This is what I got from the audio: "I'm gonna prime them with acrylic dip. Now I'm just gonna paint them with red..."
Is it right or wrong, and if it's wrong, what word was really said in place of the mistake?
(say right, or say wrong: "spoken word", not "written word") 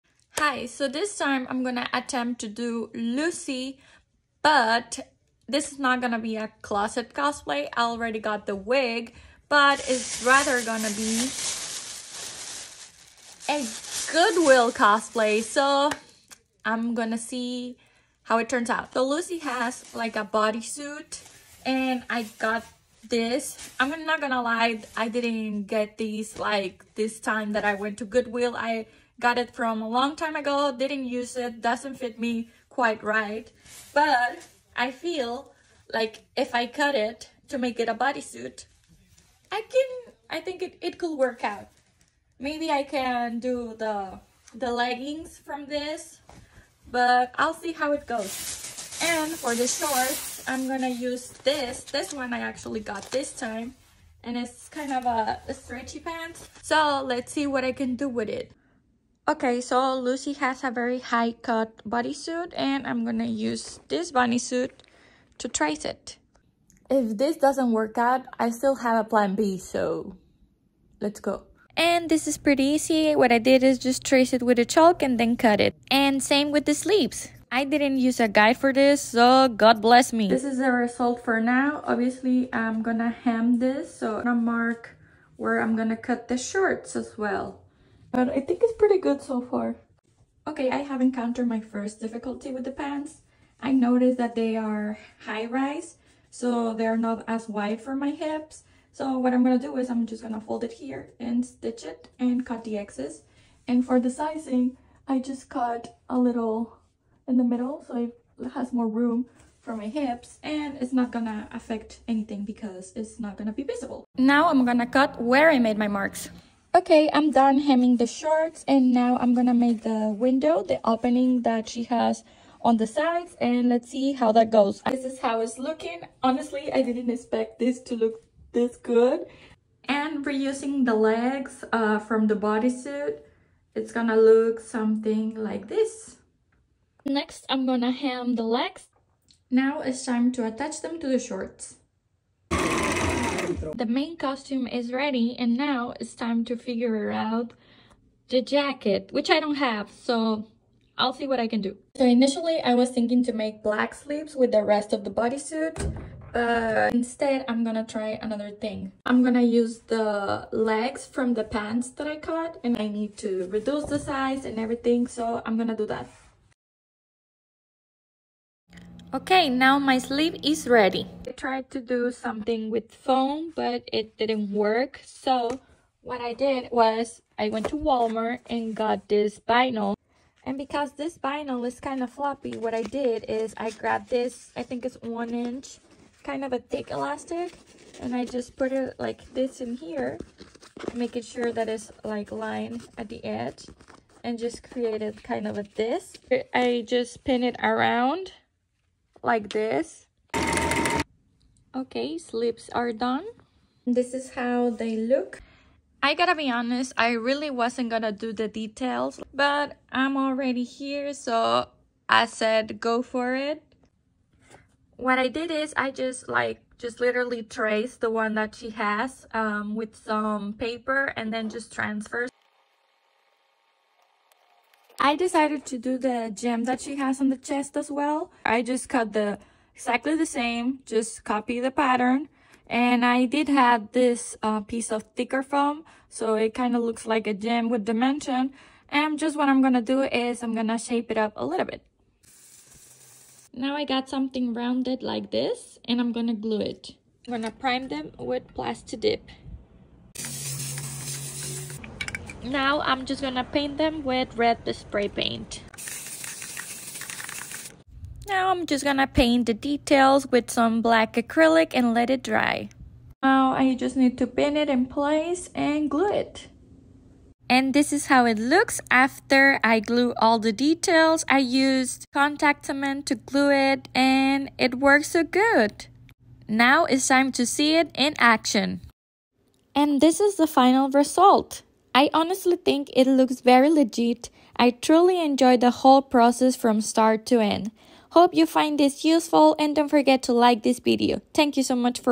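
wrong: "plastic", not "acrylic".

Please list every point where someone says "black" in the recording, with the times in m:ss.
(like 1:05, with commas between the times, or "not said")
2:33, 4:20.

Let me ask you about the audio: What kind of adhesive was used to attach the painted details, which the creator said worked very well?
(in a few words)
contact cement.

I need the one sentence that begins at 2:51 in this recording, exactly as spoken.
I tried to do something with foam, but it didn't work.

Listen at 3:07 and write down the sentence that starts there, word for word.
And I just put it like this in here, making sure that it's like lined at the edge.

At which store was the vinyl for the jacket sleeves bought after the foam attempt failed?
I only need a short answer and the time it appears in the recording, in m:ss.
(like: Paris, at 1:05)
Walmart, at 2:57.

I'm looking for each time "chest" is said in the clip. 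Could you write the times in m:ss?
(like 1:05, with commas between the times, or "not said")
3:47.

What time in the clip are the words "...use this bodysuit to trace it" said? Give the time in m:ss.
1:03.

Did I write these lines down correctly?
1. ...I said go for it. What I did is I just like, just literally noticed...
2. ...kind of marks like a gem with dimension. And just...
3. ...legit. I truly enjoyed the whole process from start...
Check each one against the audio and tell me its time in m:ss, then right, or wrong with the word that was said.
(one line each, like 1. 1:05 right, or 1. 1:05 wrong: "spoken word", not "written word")
1. 3:32 wrong: "traced", not "noticed"
2. 3:56 wrong: "looks", not "marks"
3. 4:43 right.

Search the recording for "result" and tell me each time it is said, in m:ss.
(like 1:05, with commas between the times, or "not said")
1:20, 4:40.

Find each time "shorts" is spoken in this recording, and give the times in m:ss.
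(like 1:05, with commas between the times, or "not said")
0:49, 1:26, 1:58, 2:21.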